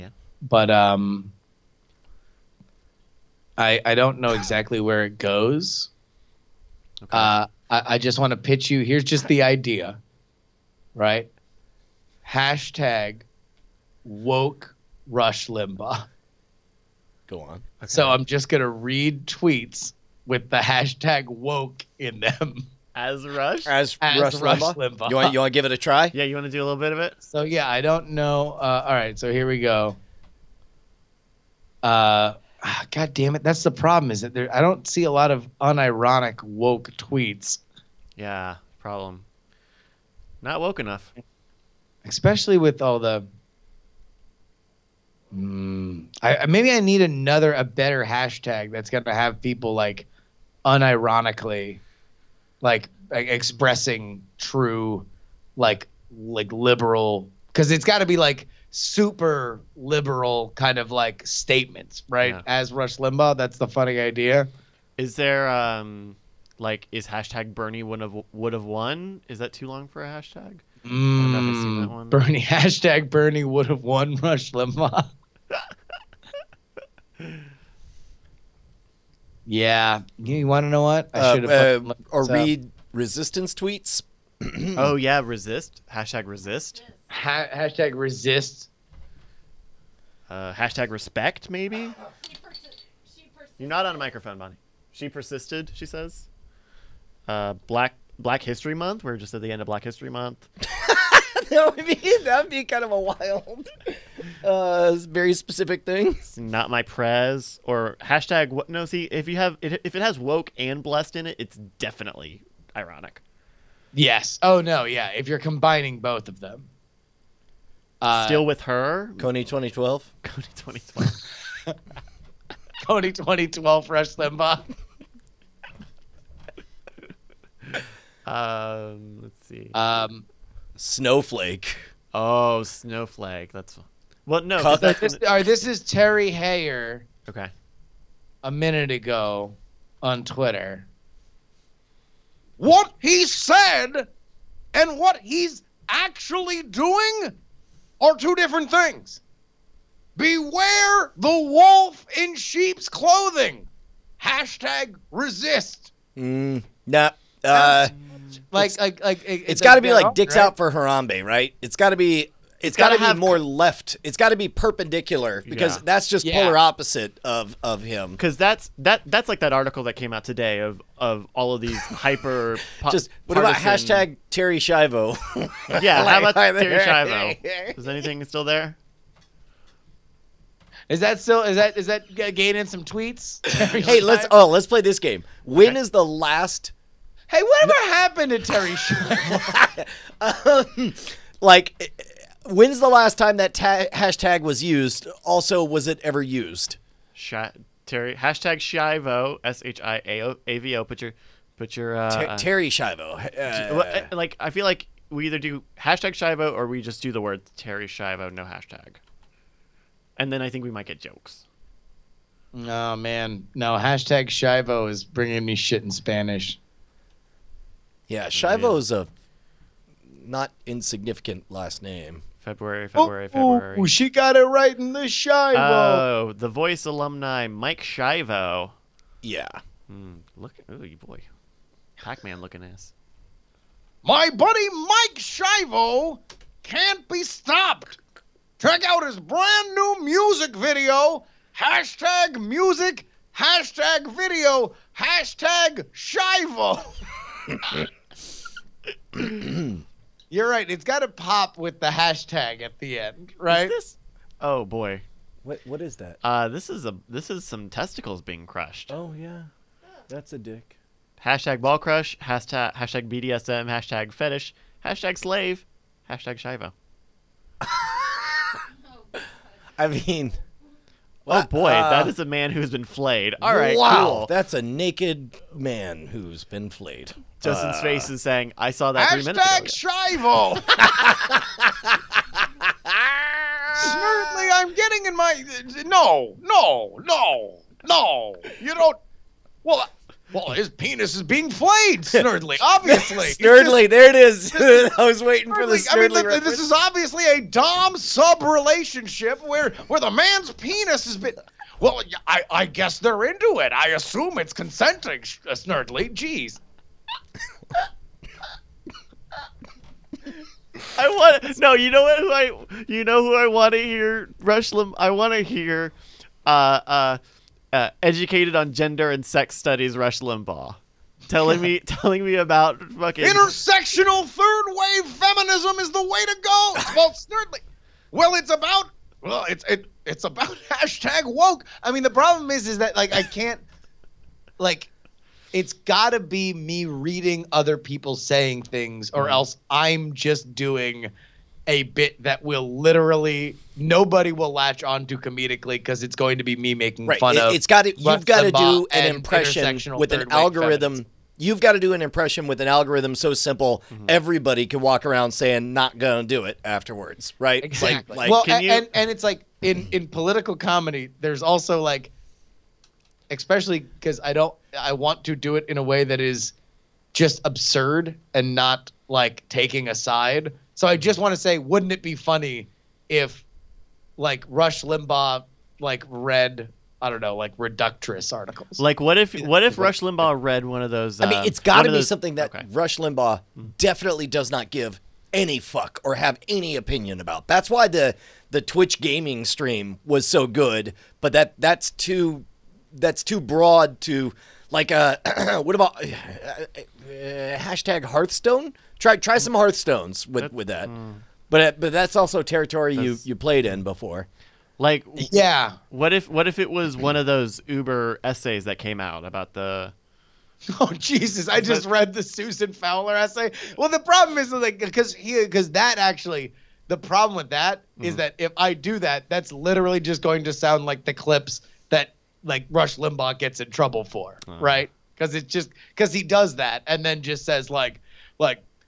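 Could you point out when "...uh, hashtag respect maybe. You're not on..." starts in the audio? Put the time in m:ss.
1:30.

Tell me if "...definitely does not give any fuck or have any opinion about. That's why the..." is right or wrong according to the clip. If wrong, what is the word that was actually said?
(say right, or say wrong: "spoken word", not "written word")
right.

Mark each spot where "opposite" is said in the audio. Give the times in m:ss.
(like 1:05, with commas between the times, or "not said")
2:46.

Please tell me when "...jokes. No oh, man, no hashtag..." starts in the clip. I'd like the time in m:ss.
3:30.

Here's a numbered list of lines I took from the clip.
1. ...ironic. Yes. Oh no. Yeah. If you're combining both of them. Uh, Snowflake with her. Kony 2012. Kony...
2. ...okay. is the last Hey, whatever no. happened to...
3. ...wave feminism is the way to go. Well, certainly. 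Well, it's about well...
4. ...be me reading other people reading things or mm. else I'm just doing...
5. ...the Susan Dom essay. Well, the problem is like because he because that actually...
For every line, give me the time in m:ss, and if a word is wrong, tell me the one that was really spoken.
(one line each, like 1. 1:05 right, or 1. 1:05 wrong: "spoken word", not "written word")
1. 1:52 wrong: "Still", not "Snowflake"
2. 3:05 right
3. 5:24 right
4. 5:36 wrong: "saying", not "reading"
5. 6:52 wrong: "Fowler", not "Dom".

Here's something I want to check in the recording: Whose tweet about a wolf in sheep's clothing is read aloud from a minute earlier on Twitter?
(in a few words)
Terry Hayer.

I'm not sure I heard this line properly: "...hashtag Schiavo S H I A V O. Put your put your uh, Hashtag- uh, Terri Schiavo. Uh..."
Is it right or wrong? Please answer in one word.
wrong.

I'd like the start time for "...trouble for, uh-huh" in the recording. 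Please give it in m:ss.
7:03.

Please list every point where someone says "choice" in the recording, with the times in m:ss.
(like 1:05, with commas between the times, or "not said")
not said.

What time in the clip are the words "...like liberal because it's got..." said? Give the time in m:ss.
0:56.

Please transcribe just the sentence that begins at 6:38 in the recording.
Try try some Hearthstones with that, with that.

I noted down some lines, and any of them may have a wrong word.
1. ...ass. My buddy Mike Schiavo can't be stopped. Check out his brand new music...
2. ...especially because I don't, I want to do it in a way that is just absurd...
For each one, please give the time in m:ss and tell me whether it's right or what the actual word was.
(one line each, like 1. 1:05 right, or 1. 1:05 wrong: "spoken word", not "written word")
1. 3:52 right
2. 6:03 right.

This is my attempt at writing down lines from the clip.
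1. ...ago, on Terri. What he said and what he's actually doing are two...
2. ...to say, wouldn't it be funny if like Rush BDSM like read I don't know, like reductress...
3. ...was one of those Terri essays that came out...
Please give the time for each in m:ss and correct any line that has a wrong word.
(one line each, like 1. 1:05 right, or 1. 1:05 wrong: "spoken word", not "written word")
1. 2:18 wrong: "Twitter", not "Terri"
2. 6:11 wrong: "Limbaugh", not "BDSM"
3. 6:46 wrong: "Uber", not "Terri".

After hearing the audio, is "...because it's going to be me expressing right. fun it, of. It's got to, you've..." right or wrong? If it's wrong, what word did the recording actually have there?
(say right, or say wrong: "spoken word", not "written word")
wrong: "making", not "expressing".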